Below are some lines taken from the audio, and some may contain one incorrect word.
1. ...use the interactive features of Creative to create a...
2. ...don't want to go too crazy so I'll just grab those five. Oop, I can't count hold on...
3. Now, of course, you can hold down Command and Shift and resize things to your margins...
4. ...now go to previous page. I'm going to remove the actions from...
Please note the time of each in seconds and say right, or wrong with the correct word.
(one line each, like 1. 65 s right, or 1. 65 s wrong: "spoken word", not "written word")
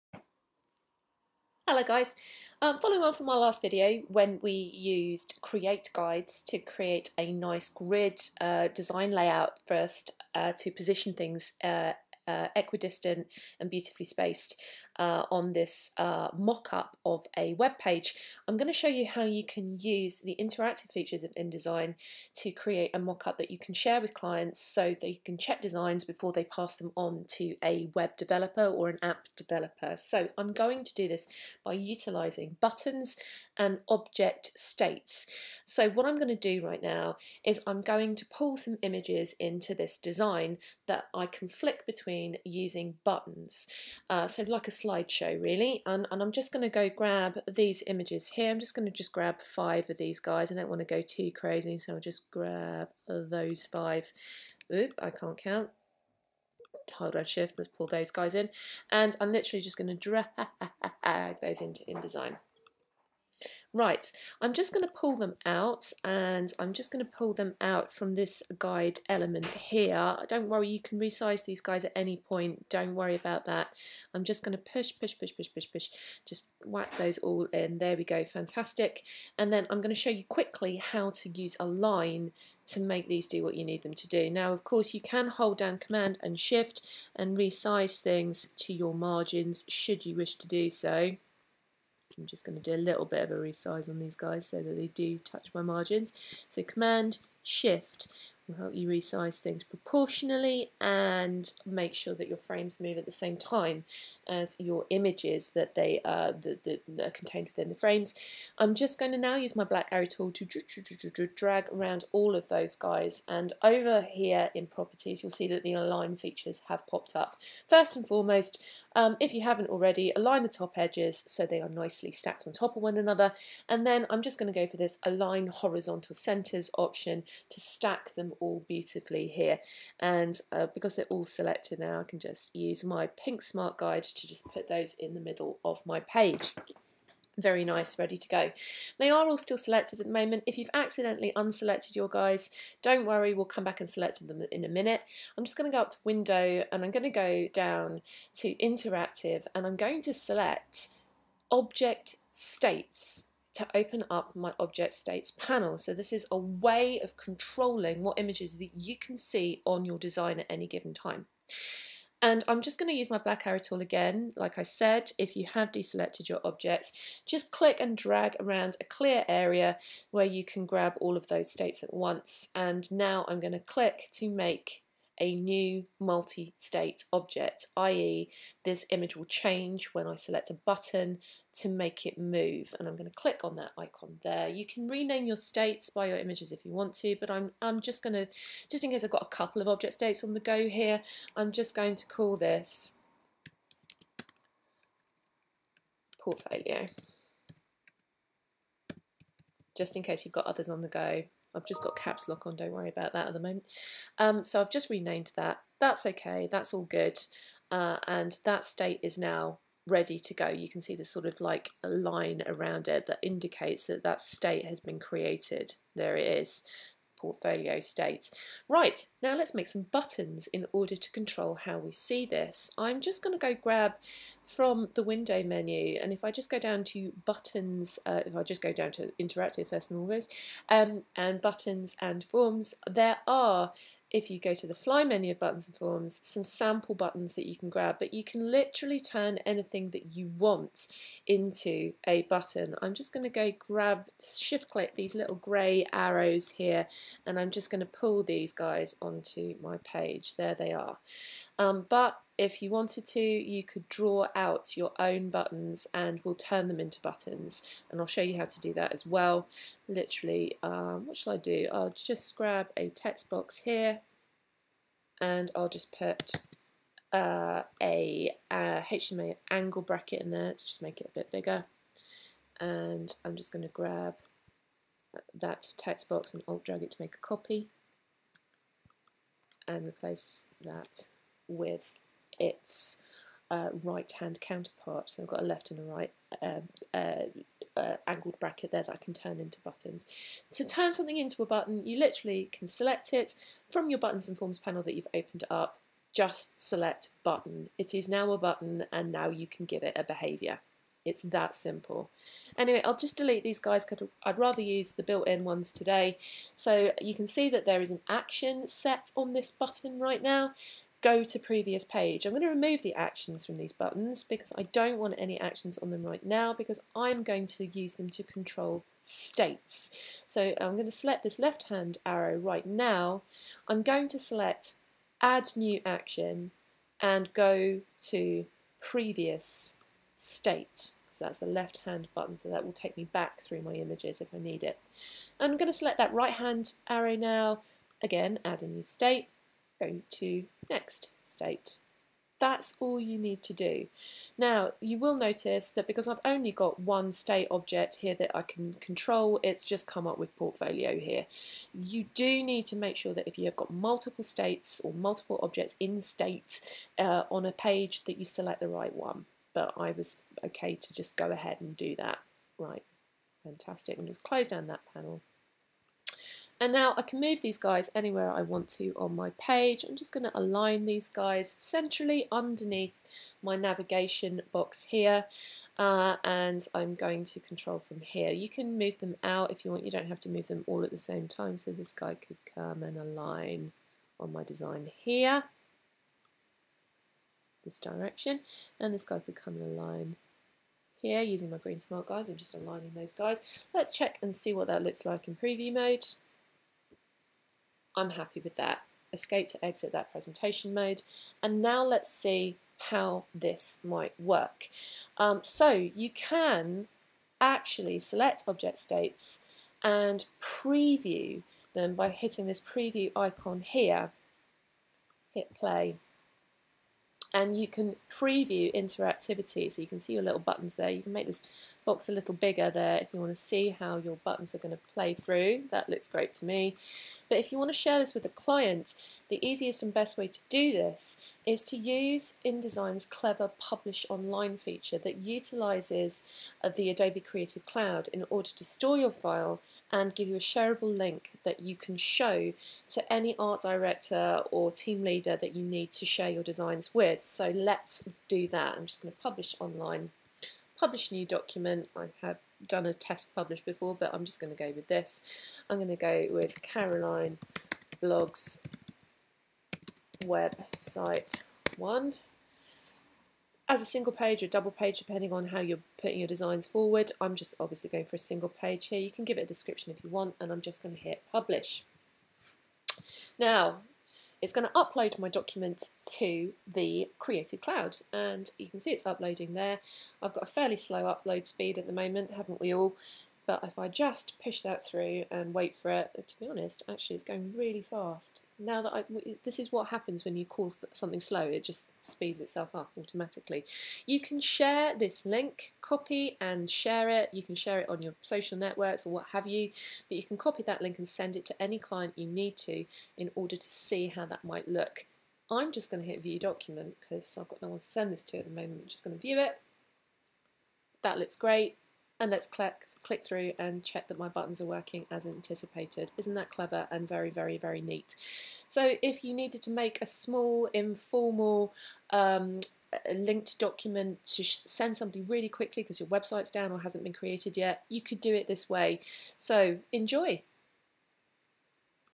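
1. 19 s wrong: "InDesign", not "Creative"
2. 50 s right
3. 84 s right
4. 310 s right.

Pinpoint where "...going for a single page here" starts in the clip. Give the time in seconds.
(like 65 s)
467 s.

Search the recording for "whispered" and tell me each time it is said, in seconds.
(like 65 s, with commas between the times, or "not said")
not said.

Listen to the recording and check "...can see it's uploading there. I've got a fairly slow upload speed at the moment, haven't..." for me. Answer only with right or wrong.
right.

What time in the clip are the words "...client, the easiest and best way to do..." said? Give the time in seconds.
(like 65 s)
428 s.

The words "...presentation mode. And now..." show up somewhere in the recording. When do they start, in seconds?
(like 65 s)
400 s.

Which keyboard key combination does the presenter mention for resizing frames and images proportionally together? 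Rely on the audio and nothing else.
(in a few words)
Command Shift.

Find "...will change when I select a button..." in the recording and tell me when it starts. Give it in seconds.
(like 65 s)
179 s.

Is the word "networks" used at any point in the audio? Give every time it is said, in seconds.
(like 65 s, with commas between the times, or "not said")
498 s.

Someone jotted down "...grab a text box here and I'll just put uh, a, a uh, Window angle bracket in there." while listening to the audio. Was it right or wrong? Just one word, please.
wrong.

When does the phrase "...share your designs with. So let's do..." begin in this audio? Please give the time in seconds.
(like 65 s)
446 s.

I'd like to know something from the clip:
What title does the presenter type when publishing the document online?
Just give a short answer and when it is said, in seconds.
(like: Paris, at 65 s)
Caroline blogs website one, at 456 s.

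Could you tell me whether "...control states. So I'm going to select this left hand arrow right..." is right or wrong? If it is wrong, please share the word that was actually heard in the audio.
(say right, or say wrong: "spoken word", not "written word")
right.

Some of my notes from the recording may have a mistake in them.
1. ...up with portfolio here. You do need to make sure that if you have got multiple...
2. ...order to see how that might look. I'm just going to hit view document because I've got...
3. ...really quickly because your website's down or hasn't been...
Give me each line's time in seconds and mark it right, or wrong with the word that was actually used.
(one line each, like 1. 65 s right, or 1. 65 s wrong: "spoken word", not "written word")
1. 350 s right
2. 503 s right
3. 525 s right.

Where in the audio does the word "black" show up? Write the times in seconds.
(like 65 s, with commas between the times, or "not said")
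109 s, 163 s.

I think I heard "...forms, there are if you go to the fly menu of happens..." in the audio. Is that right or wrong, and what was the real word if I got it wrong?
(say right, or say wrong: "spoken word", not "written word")
wrong: "buttons", not "happens".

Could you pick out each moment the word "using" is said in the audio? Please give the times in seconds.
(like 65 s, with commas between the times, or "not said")
42 s, 391 s.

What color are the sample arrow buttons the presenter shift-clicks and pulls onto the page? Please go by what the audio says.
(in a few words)
Grey.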